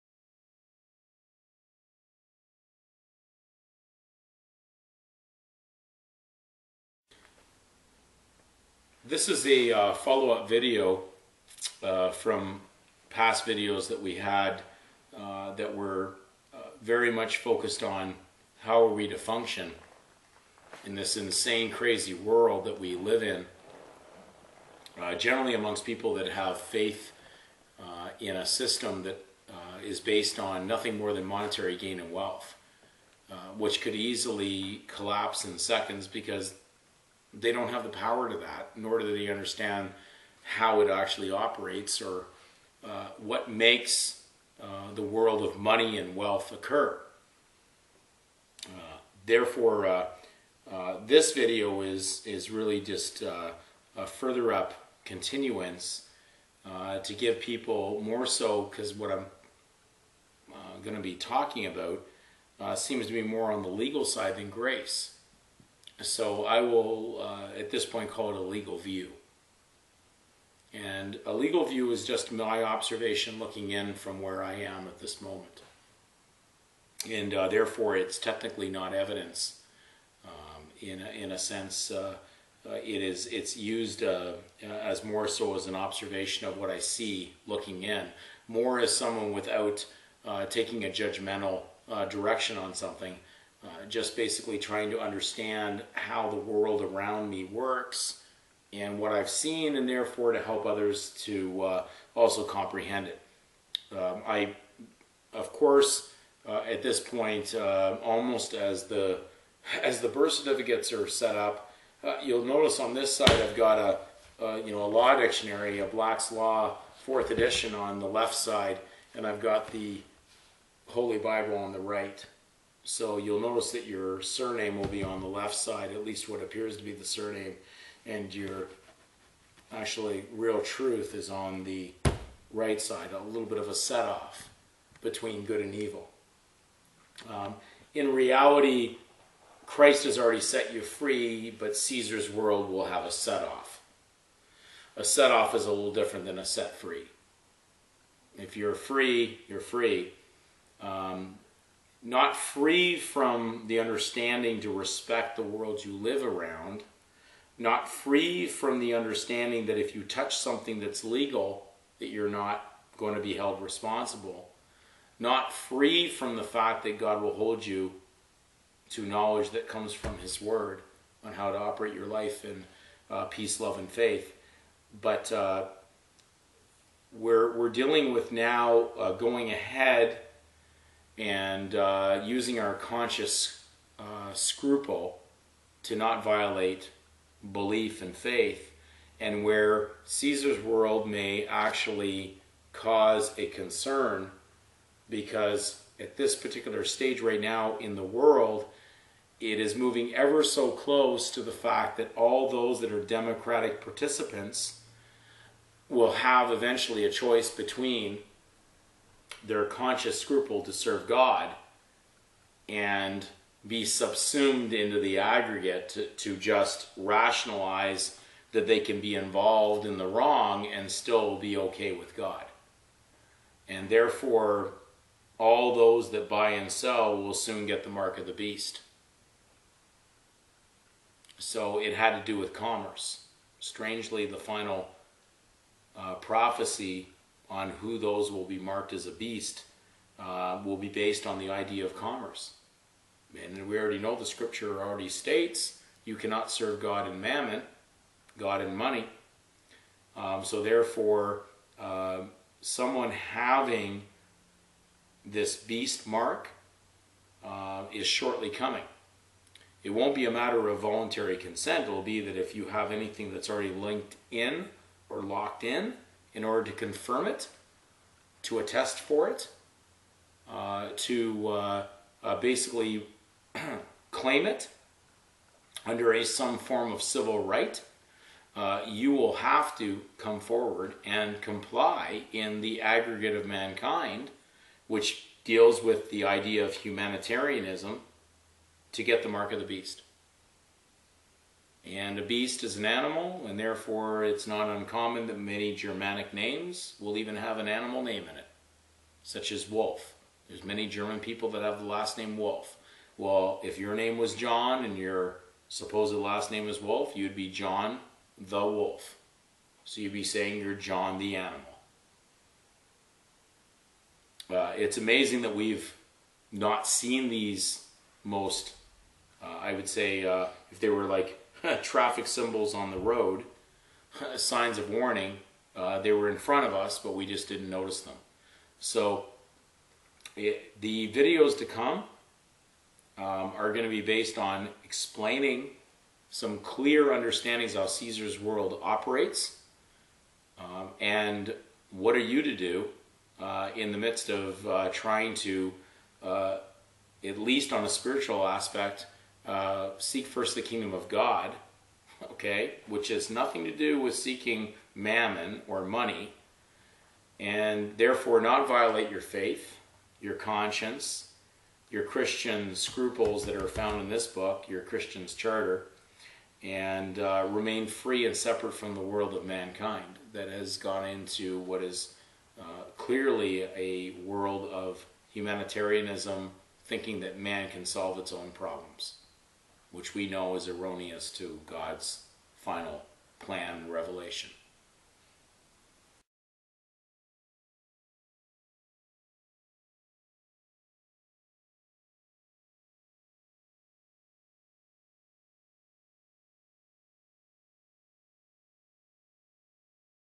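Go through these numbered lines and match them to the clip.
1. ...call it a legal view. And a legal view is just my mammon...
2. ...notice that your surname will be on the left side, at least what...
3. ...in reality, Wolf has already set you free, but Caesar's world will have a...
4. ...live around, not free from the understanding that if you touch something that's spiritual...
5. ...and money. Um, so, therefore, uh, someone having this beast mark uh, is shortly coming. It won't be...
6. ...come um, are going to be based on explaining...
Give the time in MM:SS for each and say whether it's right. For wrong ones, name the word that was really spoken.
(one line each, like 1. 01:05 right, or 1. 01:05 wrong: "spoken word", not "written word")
1. 01:08 wrong: "observation", not "mammon"
2. 02:03 right
3. 02:17 wrong: "Christ", not "Wolf"
4. 02:35 wrong: "legal", not "spiritual"
5. 04:08 right
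6. 05:31 right.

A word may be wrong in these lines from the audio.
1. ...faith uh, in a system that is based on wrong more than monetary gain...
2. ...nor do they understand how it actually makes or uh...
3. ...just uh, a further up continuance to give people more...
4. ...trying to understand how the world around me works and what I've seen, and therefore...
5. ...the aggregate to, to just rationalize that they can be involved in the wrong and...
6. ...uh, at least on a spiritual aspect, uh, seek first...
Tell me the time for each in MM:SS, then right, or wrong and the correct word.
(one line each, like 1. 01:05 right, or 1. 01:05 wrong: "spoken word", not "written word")
1. 00:26 wrong: "nothing", not "wrong"
2. 00:38 wrong: "operates", not "makes"
3. 00:52 right
4. 01:34 right
5. 03:34 right
6. 05:46 right.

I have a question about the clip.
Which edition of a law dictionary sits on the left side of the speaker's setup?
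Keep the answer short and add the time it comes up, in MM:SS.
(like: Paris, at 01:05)
Black's Law Fourth Edition, at 01:55.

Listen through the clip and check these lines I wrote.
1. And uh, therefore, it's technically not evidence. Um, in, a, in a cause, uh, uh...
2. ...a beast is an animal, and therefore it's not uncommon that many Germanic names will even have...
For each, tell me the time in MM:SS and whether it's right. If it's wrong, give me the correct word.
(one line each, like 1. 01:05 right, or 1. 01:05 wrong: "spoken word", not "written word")
1. 01:17 wrong: "sense", not "cause"
2. 04:52 right.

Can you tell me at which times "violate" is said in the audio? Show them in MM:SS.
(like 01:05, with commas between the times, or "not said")
03:06, 05:58.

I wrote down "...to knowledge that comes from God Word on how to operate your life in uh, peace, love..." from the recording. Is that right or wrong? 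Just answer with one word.
wrong.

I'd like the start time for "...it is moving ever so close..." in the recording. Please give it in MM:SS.
03:19.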